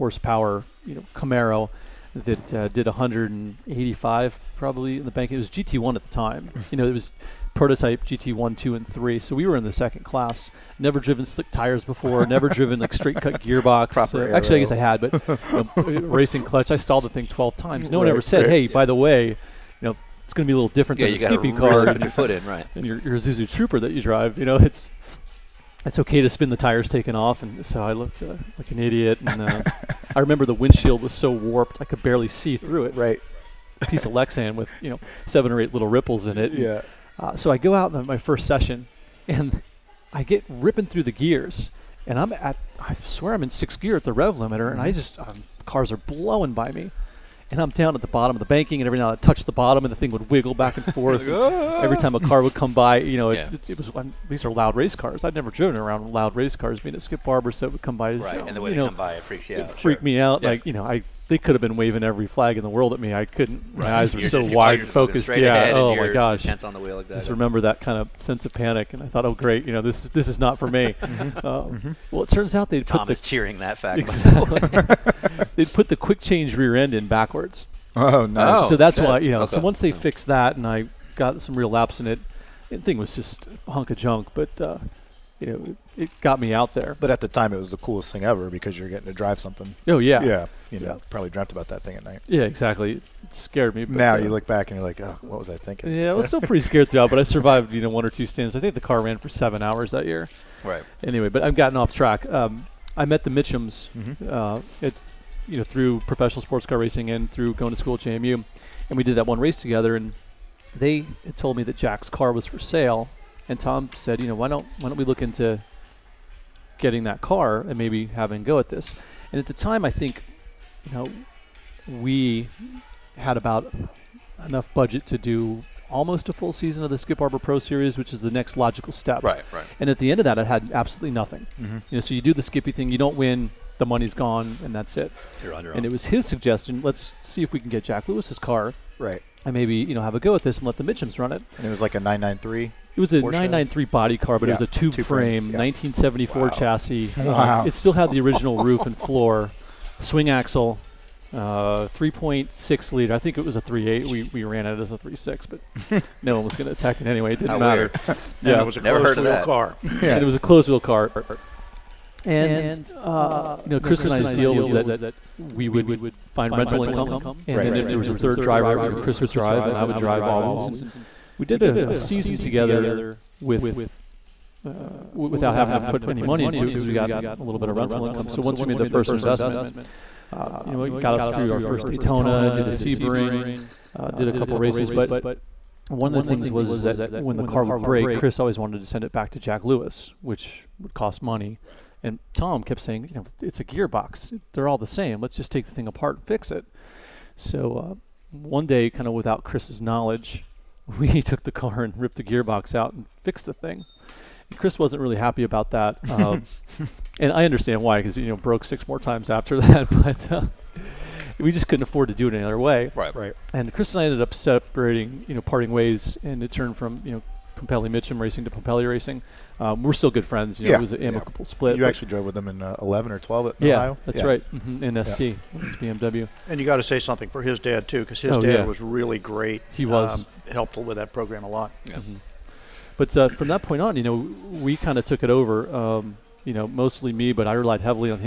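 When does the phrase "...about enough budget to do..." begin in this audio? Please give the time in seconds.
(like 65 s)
123 s.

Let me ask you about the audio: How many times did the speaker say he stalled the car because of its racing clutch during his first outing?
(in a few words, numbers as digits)
12.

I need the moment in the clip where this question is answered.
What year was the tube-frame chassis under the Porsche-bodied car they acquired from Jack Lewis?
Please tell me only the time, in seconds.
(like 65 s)
145 s.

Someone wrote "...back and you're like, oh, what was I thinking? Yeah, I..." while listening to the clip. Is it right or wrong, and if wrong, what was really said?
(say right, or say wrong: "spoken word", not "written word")
right.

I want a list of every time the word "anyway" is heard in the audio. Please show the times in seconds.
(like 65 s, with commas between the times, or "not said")
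101 s, 157 s.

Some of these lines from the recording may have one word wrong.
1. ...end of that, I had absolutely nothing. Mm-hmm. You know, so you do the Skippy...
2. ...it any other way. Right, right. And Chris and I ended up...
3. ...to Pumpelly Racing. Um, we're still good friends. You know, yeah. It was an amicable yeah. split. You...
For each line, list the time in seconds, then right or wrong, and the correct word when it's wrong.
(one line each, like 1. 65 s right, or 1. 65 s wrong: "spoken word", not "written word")
1. 130 s right
2. 212 s right
3. 218 s right.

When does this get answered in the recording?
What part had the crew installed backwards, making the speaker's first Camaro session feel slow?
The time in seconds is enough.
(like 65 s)
75 s.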